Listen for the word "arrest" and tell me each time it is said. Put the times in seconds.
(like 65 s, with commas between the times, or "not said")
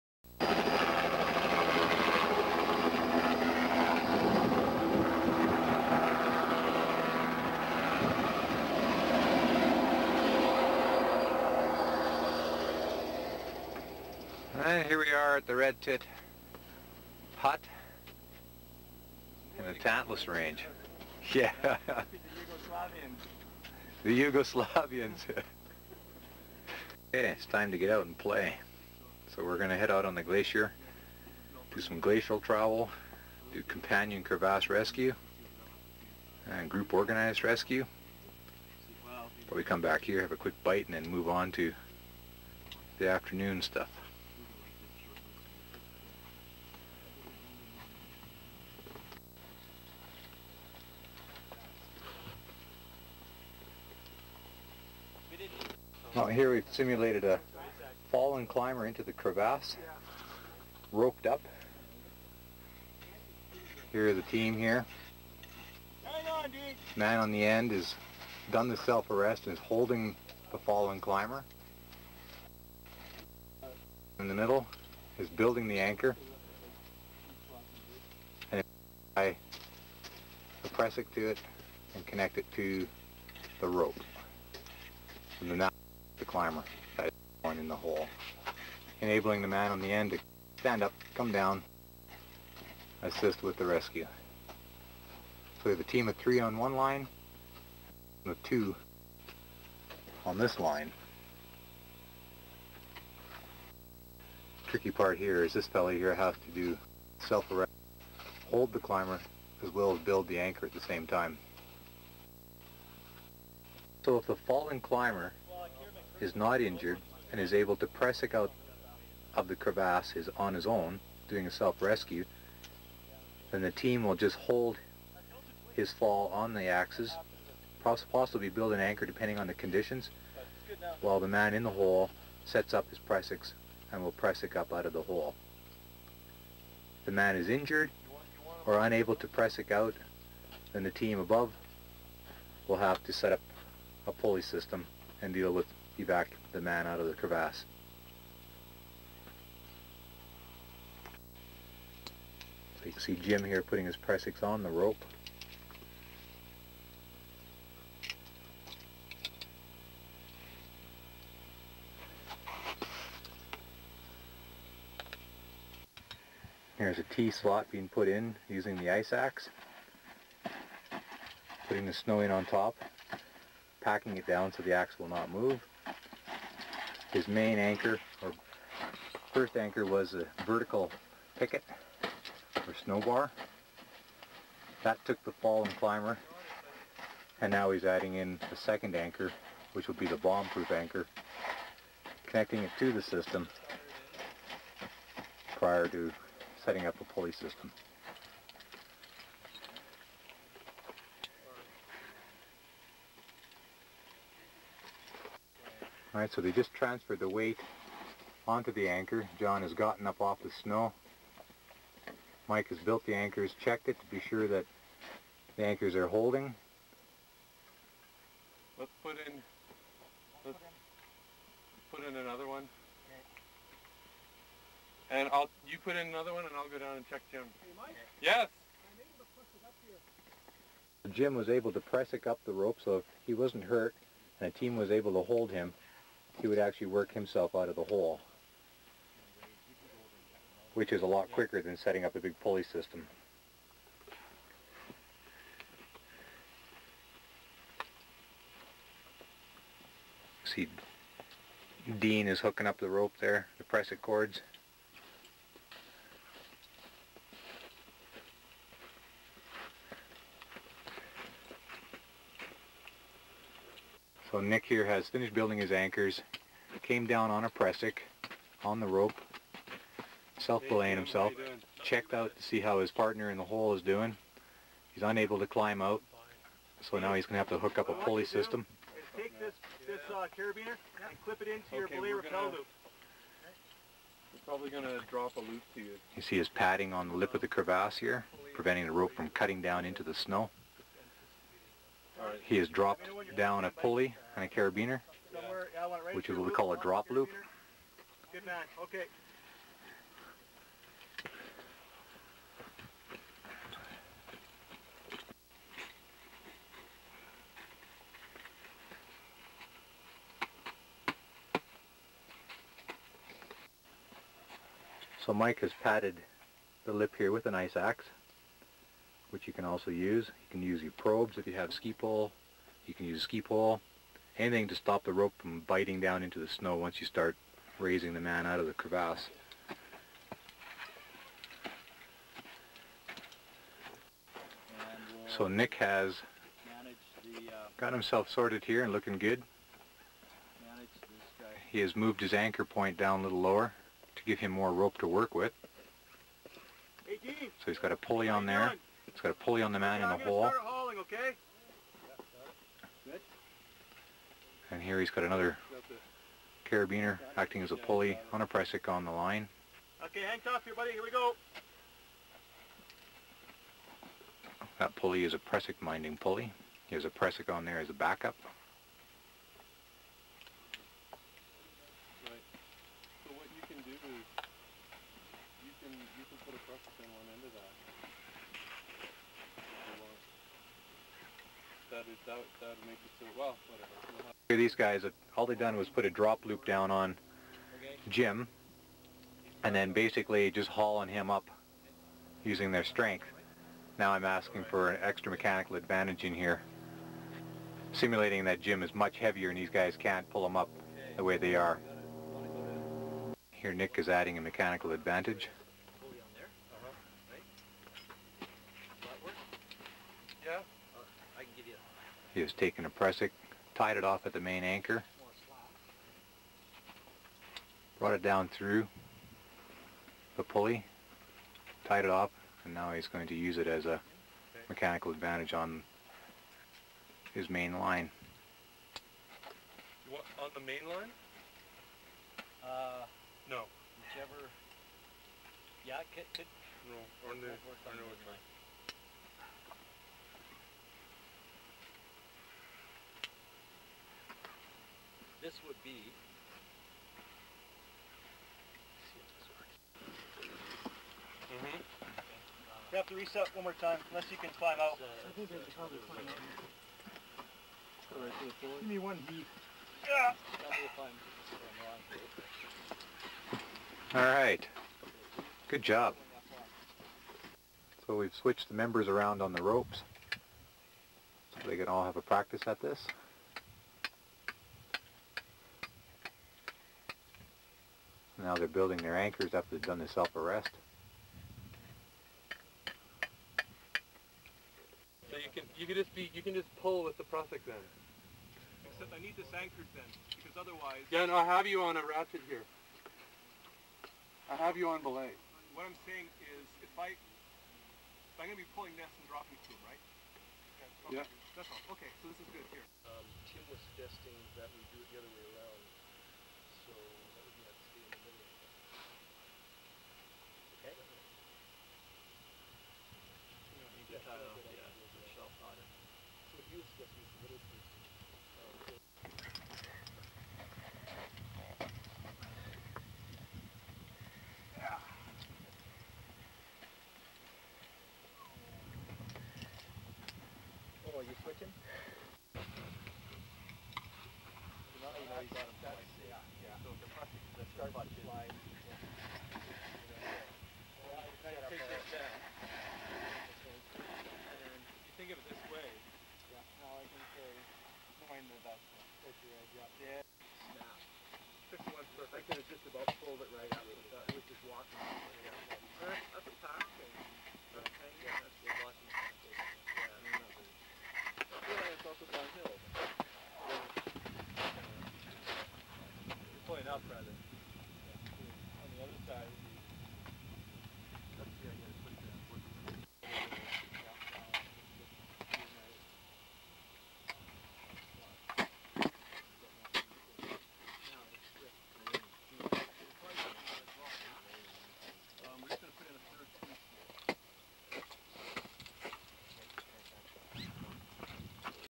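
68 s, 107 s, 480 s.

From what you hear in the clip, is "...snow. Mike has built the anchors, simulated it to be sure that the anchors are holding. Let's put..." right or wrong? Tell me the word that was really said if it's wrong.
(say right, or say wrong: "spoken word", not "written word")
wrong: "checked", not "simulated".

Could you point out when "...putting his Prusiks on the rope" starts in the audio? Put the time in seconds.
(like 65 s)
153 s.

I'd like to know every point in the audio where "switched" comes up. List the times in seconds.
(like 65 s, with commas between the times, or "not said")
468 s.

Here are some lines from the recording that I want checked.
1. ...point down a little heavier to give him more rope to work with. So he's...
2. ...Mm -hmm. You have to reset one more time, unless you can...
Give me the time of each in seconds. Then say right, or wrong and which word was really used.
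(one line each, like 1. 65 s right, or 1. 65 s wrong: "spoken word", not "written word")
1. 342 s wrong: "lower", not "heavier"
2. 451 s right.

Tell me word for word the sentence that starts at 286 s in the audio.
You see his padding on the lip of the crevasse here, preventing the rope from cutting down into the snow.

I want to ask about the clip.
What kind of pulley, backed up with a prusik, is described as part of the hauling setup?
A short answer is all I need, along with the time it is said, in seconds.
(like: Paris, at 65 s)
prusik minding pulley, at 365 s.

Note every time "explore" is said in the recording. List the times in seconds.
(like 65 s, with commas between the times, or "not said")
not said.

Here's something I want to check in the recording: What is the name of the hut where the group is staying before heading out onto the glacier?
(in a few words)
Red Tit Hut.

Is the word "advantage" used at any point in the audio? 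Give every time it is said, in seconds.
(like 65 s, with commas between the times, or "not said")
395 s, 404 s, 425 s.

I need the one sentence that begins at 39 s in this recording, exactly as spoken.
But we come back here, have a quick bite, and then move on to the afternoon stuff.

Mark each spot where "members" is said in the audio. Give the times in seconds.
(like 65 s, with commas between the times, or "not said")
468 s.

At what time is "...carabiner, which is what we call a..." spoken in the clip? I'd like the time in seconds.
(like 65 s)
294 s.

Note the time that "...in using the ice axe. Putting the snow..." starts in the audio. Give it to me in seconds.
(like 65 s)
168 s.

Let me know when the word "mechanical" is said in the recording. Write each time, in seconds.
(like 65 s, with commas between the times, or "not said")
395 s, 404 s, 424 s.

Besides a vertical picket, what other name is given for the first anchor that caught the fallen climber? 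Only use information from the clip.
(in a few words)
snow bar.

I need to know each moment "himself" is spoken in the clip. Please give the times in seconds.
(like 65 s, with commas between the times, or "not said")
237 s, 270 s, 337 s.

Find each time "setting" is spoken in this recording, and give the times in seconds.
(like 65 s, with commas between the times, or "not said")
196 s, 241 s.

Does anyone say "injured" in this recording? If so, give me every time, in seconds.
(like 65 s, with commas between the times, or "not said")
116 s, 137 s.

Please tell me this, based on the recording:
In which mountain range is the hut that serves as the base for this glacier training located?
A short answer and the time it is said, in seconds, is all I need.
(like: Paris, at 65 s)
Tantalus Range, at 19 s.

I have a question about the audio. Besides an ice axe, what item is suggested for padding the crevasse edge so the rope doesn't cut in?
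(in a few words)
probes.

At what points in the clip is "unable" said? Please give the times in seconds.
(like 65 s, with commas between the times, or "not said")
138 s, 275 s.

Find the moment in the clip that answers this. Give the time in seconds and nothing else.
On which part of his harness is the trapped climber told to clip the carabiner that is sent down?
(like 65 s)
281 s.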